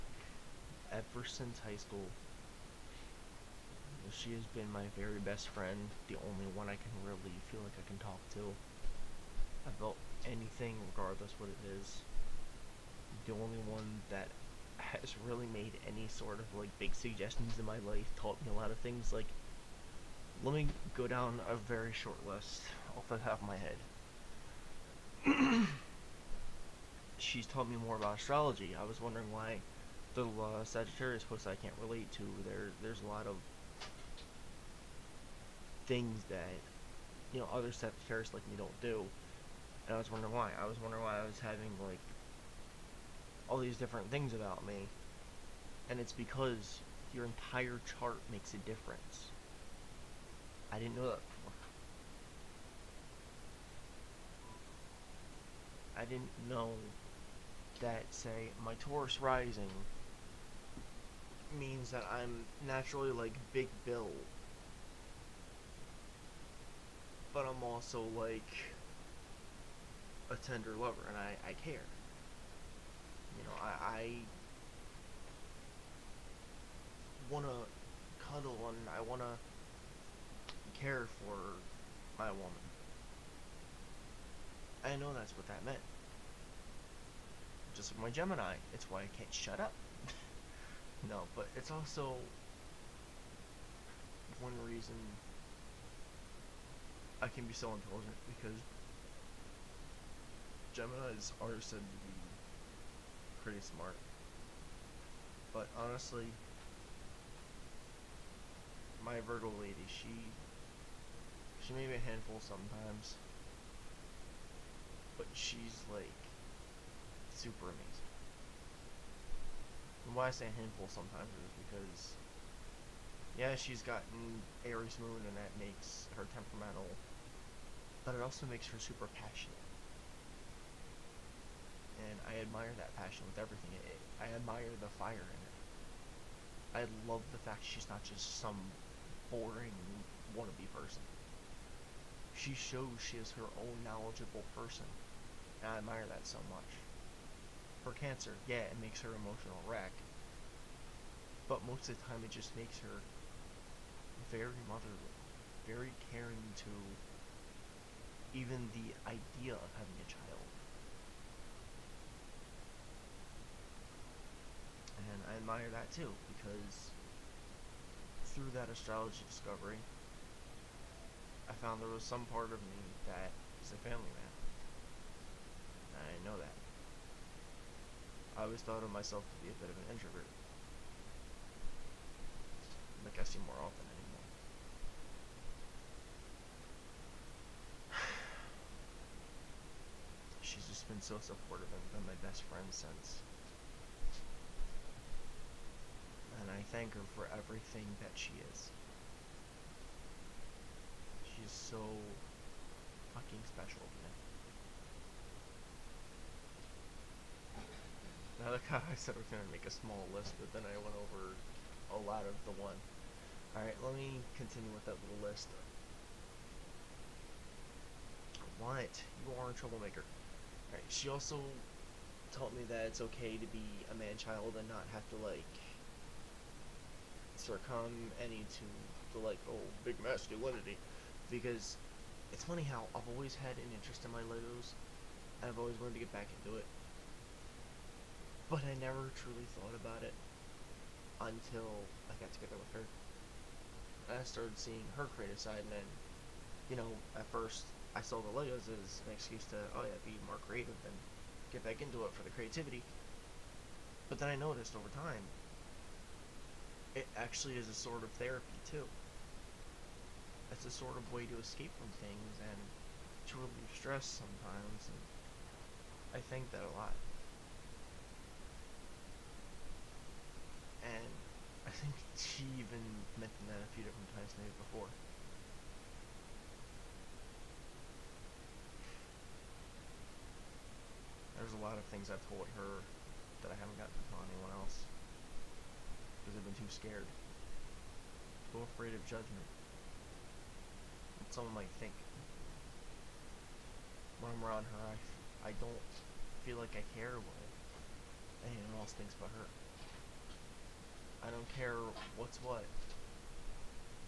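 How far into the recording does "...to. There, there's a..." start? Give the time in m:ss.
0:32.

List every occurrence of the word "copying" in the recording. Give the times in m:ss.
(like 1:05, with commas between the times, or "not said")
not said.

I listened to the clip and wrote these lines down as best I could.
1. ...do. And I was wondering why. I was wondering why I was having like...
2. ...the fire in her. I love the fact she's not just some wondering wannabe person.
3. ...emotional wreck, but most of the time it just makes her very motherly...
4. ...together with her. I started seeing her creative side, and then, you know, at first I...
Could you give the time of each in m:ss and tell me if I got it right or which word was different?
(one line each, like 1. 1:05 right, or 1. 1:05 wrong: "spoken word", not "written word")
1. 0:38 right
2. 2:14 wrong: "boring", not "wondering"
3. 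2:29 right
4. 4:02 right.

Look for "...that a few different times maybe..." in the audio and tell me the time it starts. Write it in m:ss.
4:33.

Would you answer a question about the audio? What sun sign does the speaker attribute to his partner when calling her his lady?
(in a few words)
Virgo.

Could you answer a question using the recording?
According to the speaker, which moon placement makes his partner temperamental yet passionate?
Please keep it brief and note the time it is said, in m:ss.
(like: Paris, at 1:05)
Aries moon, at 2:04.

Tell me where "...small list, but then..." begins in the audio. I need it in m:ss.
3:29.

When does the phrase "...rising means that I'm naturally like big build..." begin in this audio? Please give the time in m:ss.
0:59.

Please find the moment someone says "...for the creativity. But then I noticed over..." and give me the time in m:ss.
4:12.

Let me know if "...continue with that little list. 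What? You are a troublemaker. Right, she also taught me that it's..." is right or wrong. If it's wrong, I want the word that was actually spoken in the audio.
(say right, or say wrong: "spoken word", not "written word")
right.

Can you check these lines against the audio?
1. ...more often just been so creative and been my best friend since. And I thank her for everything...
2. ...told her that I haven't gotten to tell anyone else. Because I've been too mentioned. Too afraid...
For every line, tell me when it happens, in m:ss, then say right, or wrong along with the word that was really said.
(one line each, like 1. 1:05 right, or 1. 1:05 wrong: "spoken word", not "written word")
1. 3:03 wrong: "supportive", not "creative"
2. 4:42 wrong: "scared", not "mentioned".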